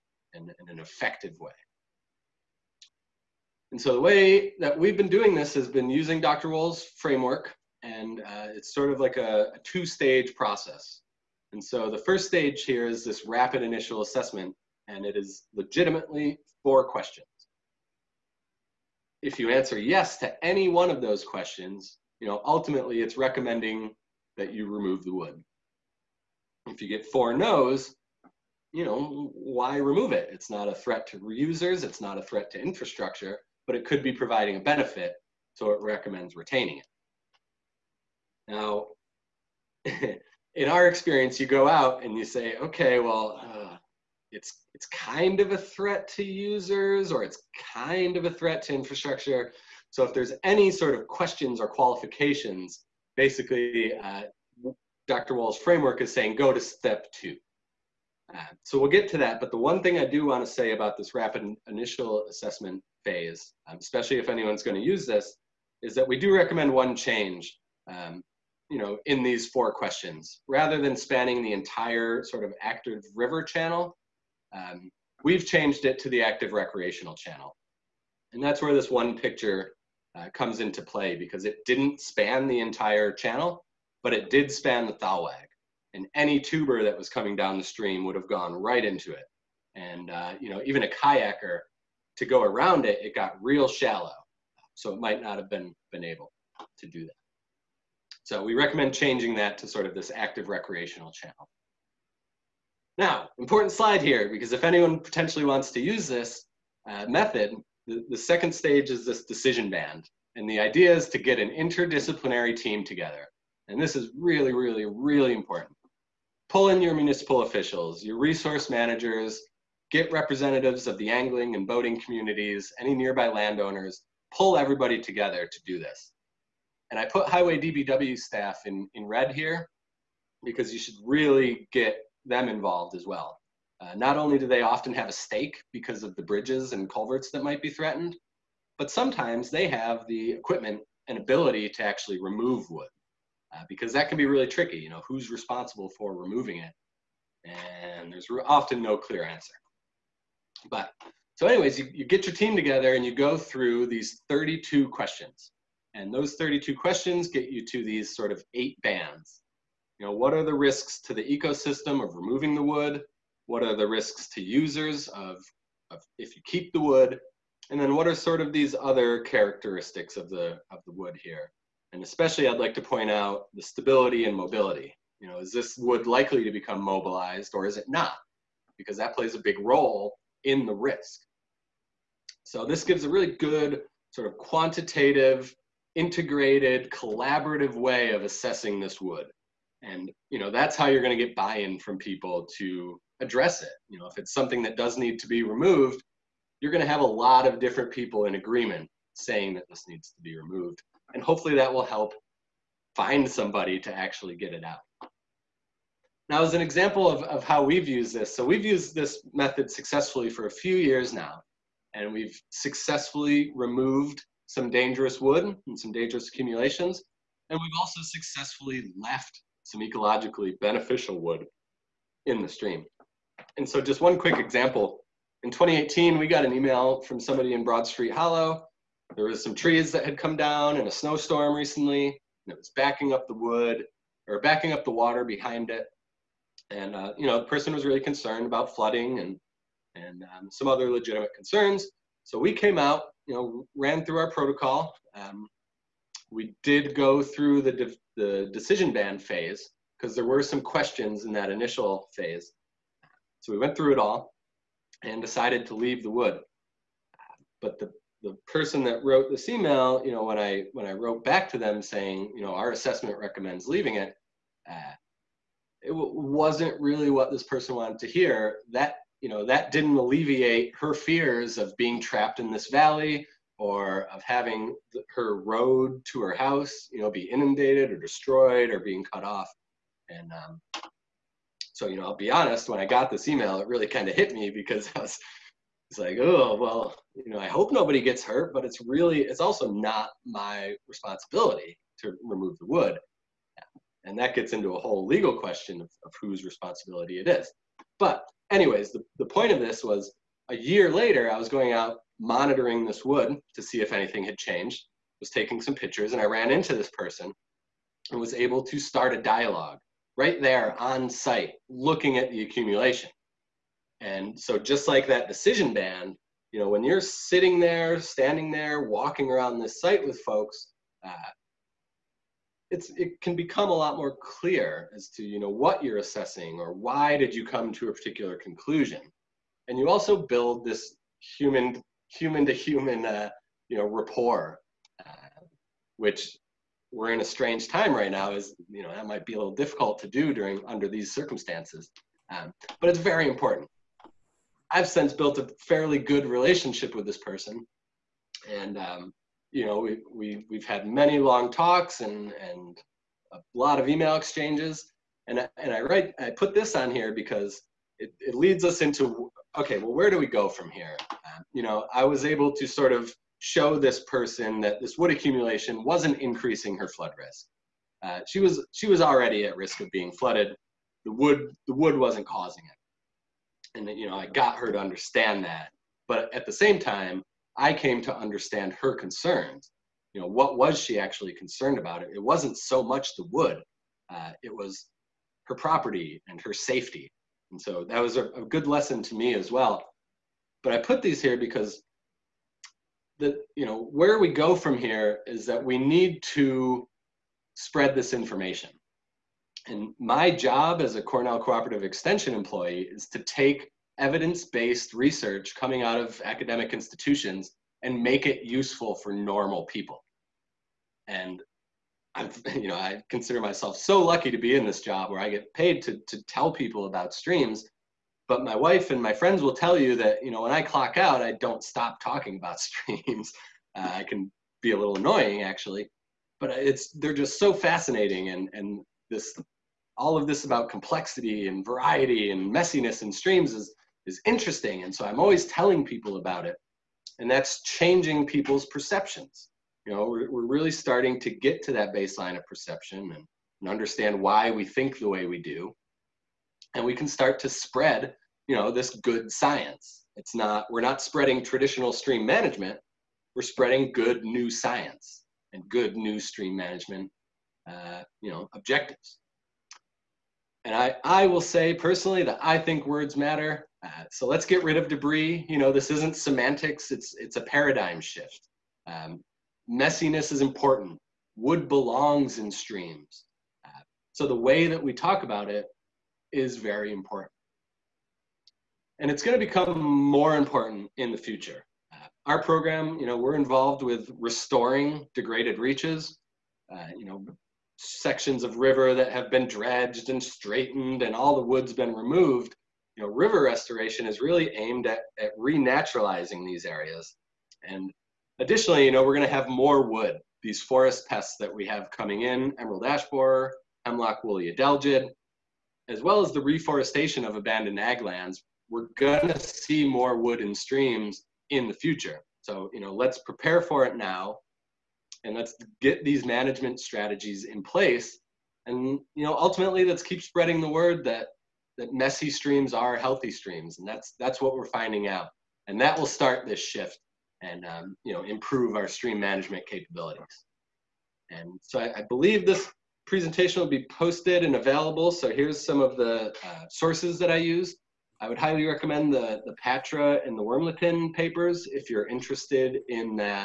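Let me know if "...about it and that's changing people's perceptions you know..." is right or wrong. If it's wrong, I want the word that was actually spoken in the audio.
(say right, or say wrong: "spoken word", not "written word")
right.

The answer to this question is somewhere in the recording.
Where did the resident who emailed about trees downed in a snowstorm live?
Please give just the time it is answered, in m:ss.
3:47.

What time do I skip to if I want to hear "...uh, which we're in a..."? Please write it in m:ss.
5:35.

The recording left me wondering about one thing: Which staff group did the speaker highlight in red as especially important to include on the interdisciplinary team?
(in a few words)
Highway DPW staff.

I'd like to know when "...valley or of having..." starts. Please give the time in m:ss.
4:32.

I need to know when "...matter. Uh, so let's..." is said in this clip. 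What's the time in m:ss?
7:43.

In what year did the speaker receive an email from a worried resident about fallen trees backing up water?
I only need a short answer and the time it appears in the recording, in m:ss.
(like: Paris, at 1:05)
2018, at 3:45.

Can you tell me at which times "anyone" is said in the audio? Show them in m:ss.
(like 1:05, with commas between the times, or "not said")
1:04, 1:44.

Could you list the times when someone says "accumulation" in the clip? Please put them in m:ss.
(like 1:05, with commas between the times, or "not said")
3:36, 5:12, 6:05.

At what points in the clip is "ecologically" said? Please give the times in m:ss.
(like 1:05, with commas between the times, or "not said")
3:39.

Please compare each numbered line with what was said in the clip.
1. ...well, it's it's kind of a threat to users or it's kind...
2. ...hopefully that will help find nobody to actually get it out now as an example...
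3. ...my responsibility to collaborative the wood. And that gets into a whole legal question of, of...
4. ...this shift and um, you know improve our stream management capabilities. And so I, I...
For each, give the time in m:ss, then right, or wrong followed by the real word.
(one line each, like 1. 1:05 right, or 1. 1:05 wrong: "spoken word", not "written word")
1. 0:42 right
2. 3:21 wrong: "somebody", not "nobody"
3. 4:50 wrong: "remove", not "collaborative"
4. 8:46 right.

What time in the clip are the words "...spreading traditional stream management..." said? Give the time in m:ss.
7:31.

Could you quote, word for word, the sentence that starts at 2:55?
You know, is this wood likely to become mobilized or is it not?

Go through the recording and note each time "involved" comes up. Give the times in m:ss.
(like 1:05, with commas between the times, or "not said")
2:12, 8:03.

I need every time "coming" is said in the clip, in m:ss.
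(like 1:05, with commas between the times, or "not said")
1:27, 6:45, 8:21.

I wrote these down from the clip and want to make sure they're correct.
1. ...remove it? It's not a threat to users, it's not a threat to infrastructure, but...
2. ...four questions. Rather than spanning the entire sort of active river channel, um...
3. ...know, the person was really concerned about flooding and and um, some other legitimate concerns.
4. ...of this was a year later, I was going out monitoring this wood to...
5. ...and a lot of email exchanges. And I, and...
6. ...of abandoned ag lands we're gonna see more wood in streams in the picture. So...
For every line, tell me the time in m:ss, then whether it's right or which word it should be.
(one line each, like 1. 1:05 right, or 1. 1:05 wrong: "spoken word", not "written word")
1. 0:29 right
2. 1:09 right
3. 3:57 right
4. 4:59 right
5. 5:52 right
6. 8:27 wrong: "future", not "picture".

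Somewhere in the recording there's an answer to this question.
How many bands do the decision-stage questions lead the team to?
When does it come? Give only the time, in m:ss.
2:38.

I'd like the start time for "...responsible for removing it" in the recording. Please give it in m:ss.
2:25.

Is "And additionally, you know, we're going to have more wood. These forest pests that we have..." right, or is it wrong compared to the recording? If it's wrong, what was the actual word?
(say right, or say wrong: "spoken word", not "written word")
right.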